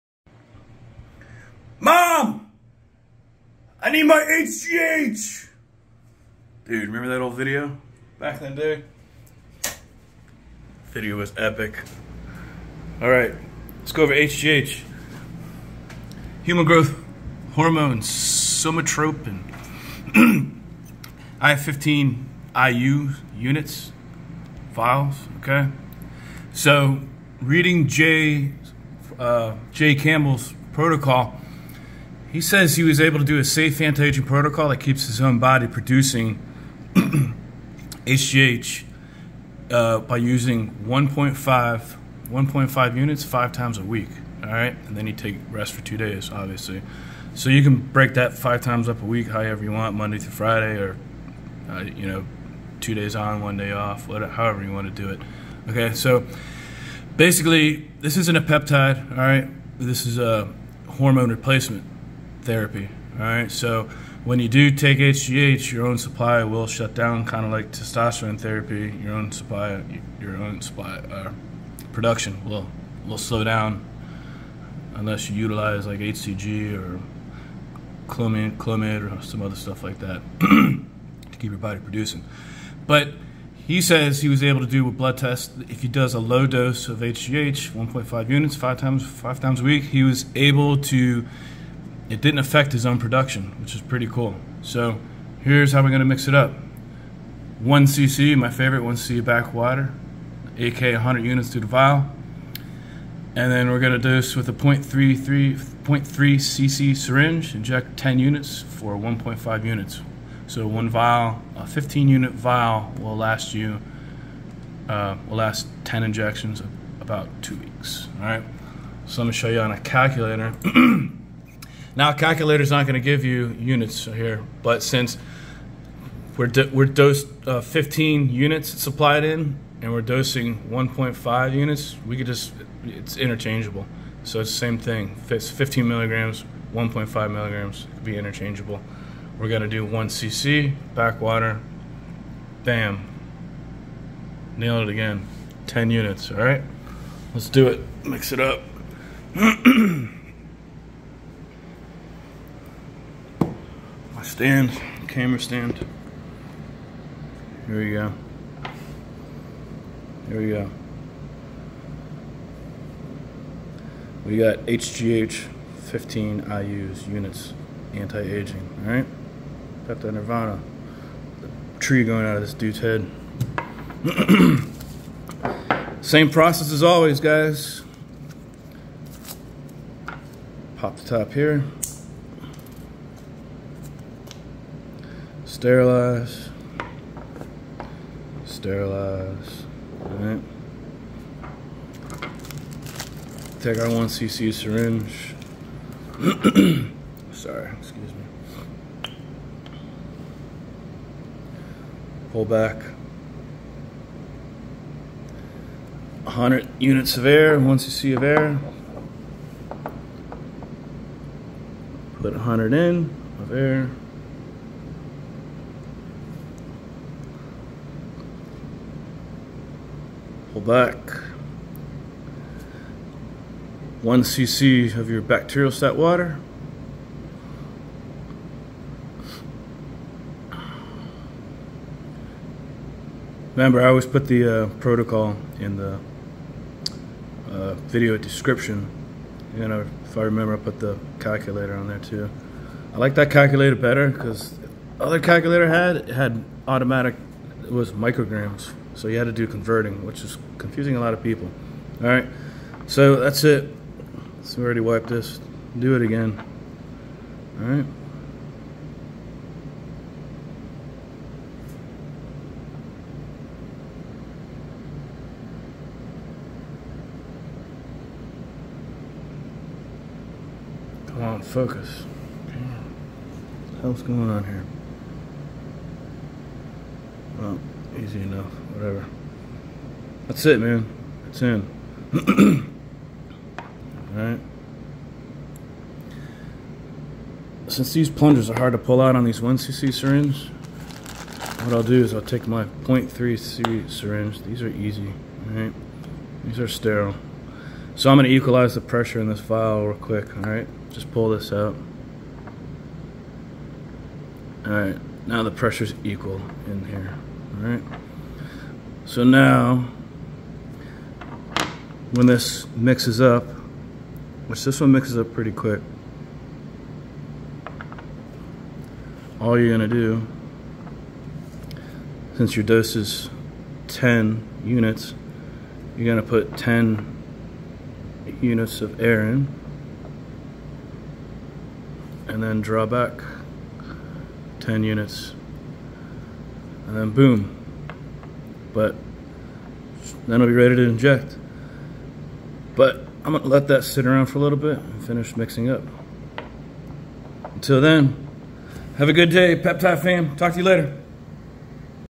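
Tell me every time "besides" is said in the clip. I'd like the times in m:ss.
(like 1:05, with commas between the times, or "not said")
not said.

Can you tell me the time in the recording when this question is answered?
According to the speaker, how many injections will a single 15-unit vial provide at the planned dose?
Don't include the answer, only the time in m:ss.
1:55.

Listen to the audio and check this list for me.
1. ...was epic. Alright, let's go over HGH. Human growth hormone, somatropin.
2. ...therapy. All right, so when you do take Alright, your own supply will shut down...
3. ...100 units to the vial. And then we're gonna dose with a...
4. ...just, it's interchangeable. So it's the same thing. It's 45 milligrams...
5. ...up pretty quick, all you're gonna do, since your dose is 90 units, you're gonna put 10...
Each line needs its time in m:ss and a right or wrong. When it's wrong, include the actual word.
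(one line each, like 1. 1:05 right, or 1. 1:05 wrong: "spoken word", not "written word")
1. 0:11 right
2. 1:02 wrong: "HGH", not "Alright"
3. 1:40 right
4. 2:12 wrong: "15", not "45"
5. 5:15 wrong: "10", not "90".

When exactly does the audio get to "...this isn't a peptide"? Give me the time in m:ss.
0:57.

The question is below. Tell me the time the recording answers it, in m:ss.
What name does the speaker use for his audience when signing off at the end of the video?
5:49.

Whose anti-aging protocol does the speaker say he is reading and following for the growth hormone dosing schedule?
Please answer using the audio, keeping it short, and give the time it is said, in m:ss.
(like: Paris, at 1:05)
Jay Campbell, at 0:29.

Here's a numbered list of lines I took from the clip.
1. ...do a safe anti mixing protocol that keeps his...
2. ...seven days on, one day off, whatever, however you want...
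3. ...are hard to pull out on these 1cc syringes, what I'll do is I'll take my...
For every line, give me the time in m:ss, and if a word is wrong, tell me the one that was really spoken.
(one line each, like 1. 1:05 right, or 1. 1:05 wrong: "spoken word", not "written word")
1. 0:33 wrong: "aging", not "mixing"
2. 0:52 wrong: "two", not "seven"
3. 4:48 right.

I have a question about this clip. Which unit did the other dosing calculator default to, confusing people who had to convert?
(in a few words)
micrograms.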